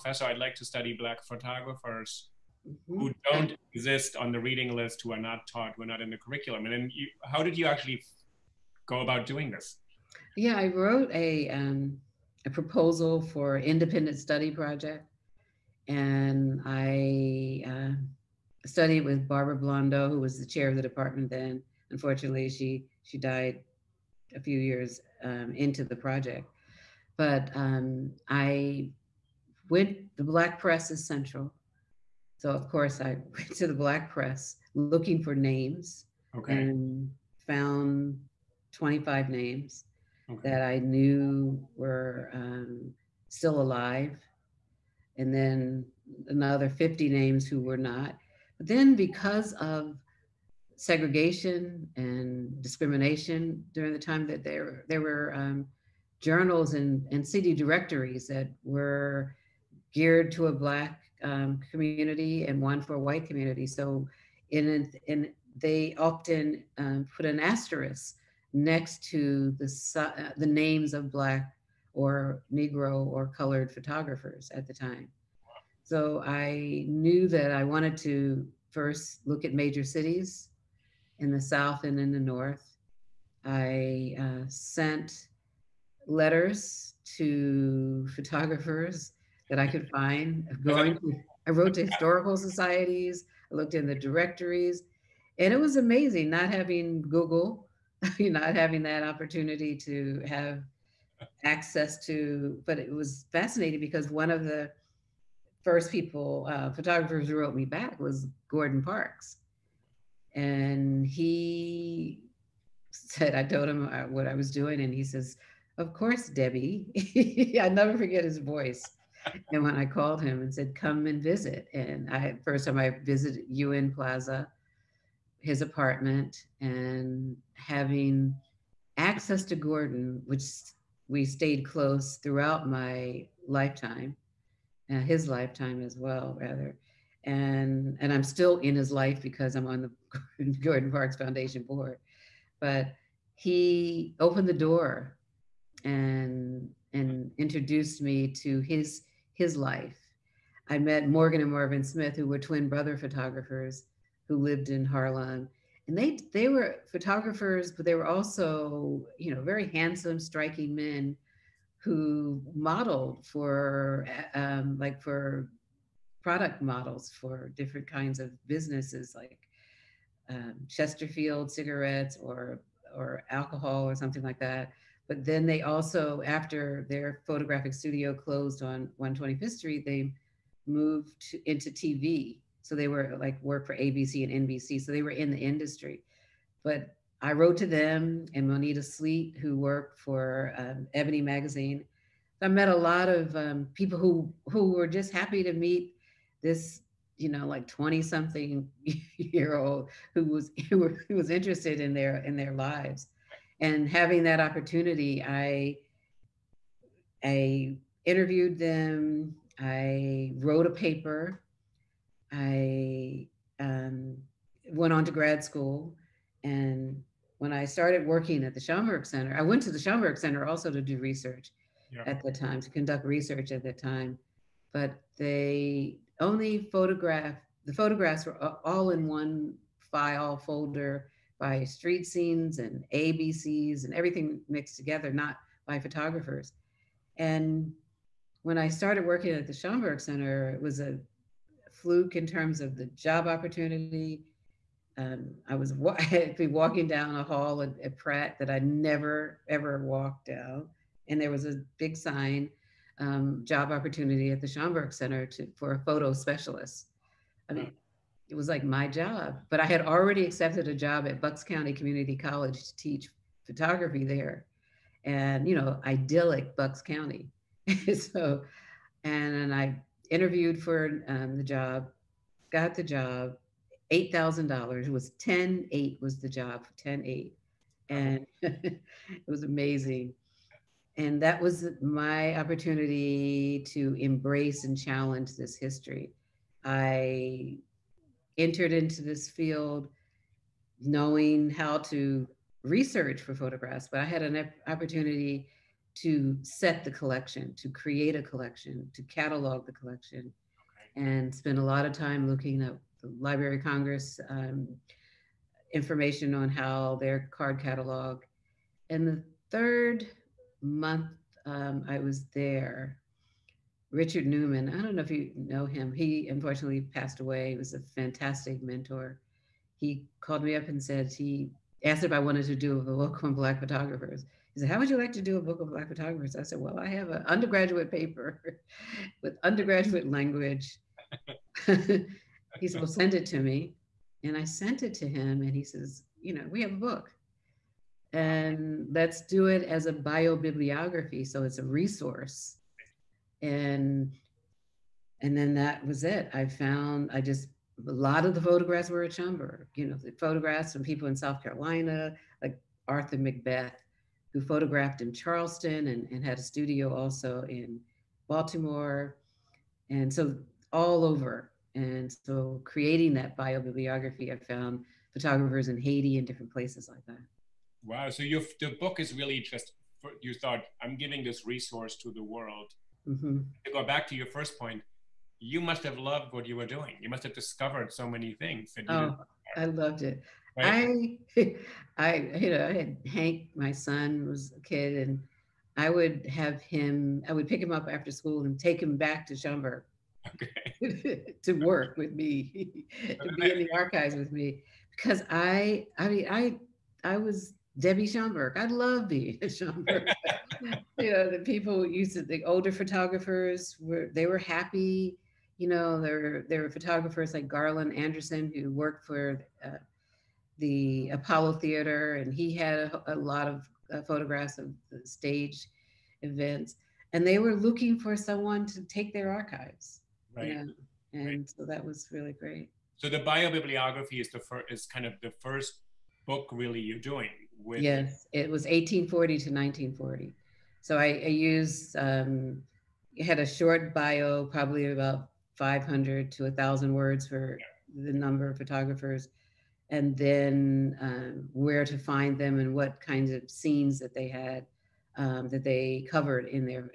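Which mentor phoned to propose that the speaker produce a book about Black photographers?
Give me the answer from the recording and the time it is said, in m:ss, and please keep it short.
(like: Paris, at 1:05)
Richard Newman, at 5:13.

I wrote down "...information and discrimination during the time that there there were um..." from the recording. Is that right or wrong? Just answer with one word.
wrong.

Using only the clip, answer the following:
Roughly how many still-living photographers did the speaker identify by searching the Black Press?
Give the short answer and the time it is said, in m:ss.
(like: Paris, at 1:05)
25, at 0:38.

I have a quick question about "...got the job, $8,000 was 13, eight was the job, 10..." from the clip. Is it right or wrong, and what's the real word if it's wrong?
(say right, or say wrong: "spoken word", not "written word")
wrong: "10", not "13".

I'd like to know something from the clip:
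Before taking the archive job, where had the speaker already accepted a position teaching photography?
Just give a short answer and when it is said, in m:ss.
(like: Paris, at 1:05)
Bucks County Community College, at 4:21.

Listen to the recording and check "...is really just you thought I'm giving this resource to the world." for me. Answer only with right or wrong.
right.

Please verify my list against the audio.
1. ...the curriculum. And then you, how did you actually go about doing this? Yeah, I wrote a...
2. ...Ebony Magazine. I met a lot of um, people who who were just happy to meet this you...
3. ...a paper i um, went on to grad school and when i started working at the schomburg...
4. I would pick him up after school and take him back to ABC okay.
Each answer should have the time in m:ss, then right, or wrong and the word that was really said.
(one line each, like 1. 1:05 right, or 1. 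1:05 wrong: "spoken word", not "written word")
1. 0:06 right
2. 3:10 right
3. 3:30 right
4. 6:27 wrong: "Schomburg", not "ABC".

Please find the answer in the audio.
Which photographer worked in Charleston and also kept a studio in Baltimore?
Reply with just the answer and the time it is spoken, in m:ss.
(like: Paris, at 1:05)
Arthur Macbeth, at 5:52.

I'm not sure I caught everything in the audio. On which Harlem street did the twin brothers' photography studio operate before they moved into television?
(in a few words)
125th Street.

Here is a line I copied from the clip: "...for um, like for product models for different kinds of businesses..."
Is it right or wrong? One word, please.
right.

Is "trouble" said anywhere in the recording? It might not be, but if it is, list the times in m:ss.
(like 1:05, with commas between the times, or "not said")
not said.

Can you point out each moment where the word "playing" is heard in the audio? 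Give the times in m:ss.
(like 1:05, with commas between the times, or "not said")
not said.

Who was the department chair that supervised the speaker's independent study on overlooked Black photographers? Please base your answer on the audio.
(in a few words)
Barbara Blondeau.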